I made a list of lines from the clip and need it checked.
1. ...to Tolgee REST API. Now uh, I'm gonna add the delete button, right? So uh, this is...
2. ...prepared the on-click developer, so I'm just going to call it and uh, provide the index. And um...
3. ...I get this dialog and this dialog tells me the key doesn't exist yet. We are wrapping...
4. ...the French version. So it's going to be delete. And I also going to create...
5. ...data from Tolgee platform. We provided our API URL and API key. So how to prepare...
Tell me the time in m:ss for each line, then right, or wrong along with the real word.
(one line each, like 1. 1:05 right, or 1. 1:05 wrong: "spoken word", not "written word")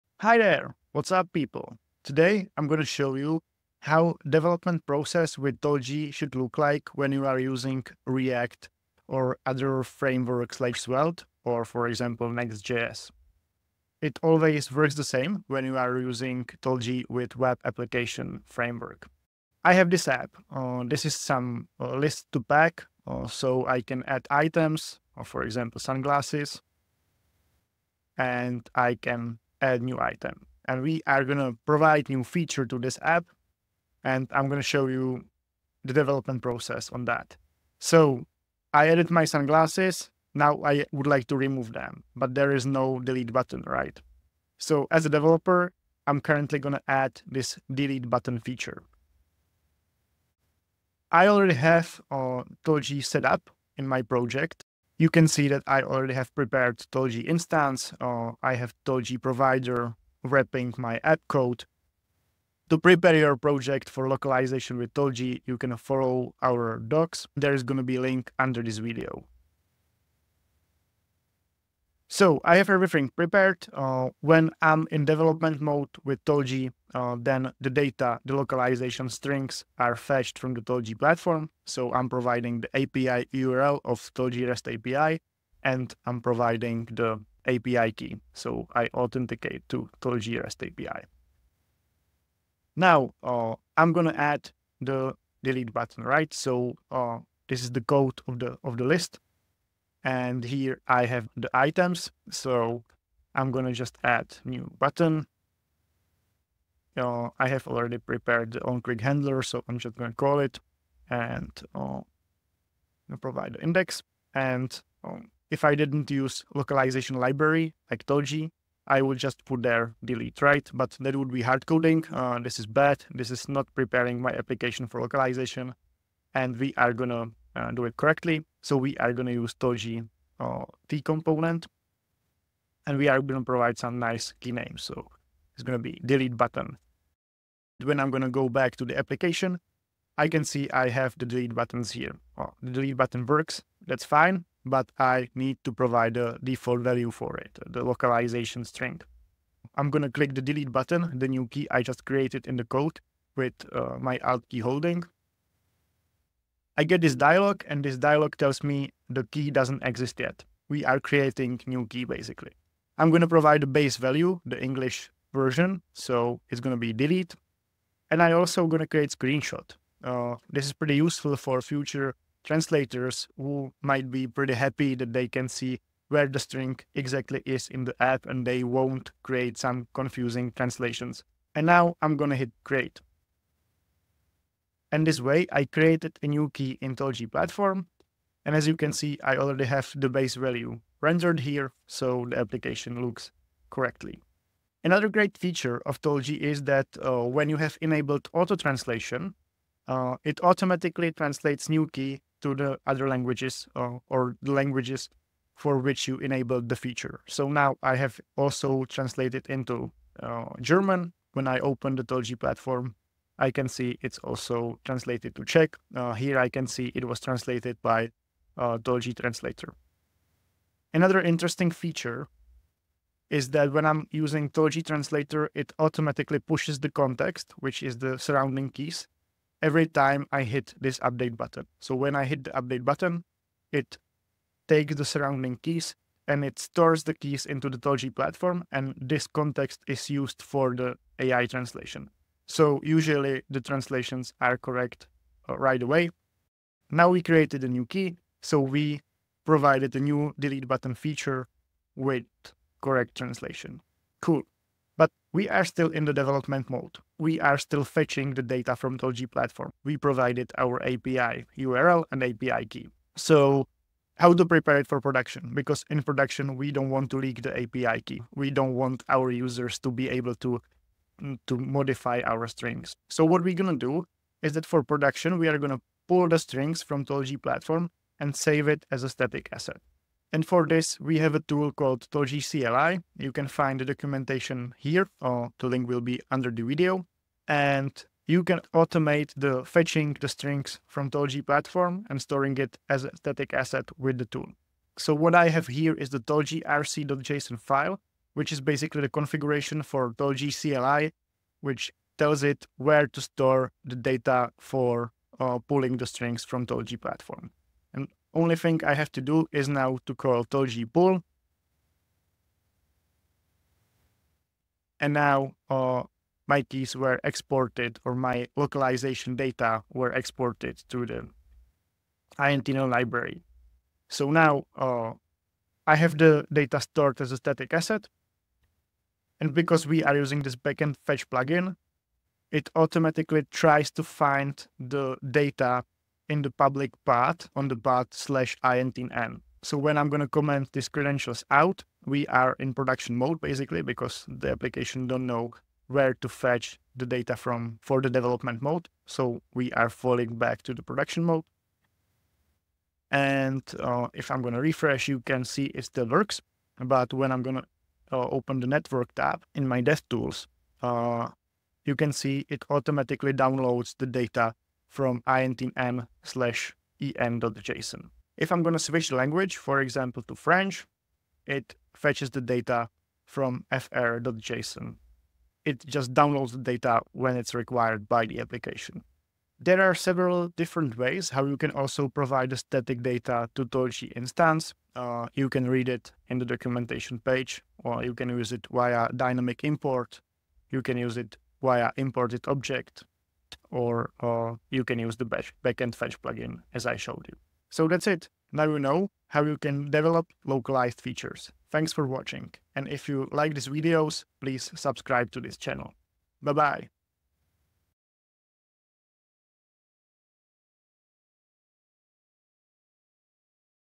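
1. 1:29 right
2. 1:47 wrong: "handler", not "developer"
3. 2:36 wrong: "creating", not "wrapping"
4. 2:44 wrong: "English", not "French"
5. 4:18 right.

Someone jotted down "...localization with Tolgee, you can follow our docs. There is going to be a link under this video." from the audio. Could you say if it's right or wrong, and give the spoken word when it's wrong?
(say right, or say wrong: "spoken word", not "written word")
right.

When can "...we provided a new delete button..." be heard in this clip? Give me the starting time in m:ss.
4:08.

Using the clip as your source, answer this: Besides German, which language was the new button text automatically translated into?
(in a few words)
Czech.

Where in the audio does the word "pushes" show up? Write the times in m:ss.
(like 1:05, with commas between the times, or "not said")
3:46.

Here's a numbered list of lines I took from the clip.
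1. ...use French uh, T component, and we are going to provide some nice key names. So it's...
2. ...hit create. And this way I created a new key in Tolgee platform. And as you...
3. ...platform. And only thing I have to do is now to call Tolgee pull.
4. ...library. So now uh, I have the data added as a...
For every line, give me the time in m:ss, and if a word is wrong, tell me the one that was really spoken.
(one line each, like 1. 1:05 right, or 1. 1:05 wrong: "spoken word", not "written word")
1. 2:09 wrong: "Tolgee", not "French"
2. 3:02 right
3. 5:07 right
4. 5:22 wrong: "stored", not "added".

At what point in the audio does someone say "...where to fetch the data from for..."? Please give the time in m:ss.
5:45.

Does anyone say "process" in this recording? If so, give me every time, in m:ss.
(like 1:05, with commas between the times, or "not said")
0:04, 0:36.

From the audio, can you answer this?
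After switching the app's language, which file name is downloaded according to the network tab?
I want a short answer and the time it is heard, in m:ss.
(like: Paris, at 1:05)
fr.json, at 6:13.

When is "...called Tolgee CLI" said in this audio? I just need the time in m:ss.
4:41.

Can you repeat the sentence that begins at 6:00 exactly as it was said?
tools, uh, you can see it automatically downloads the data from intm slash en.json.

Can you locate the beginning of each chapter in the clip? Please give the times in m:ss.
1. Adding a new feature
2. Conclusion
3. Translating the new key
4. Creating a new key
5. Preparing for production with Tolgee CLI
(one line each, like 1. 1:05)
1. 0:19
2. 6:37
3. 3:14
4. 2:08
5. 4:06.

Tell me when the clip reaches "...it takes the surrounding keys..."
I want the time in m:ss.
3:53.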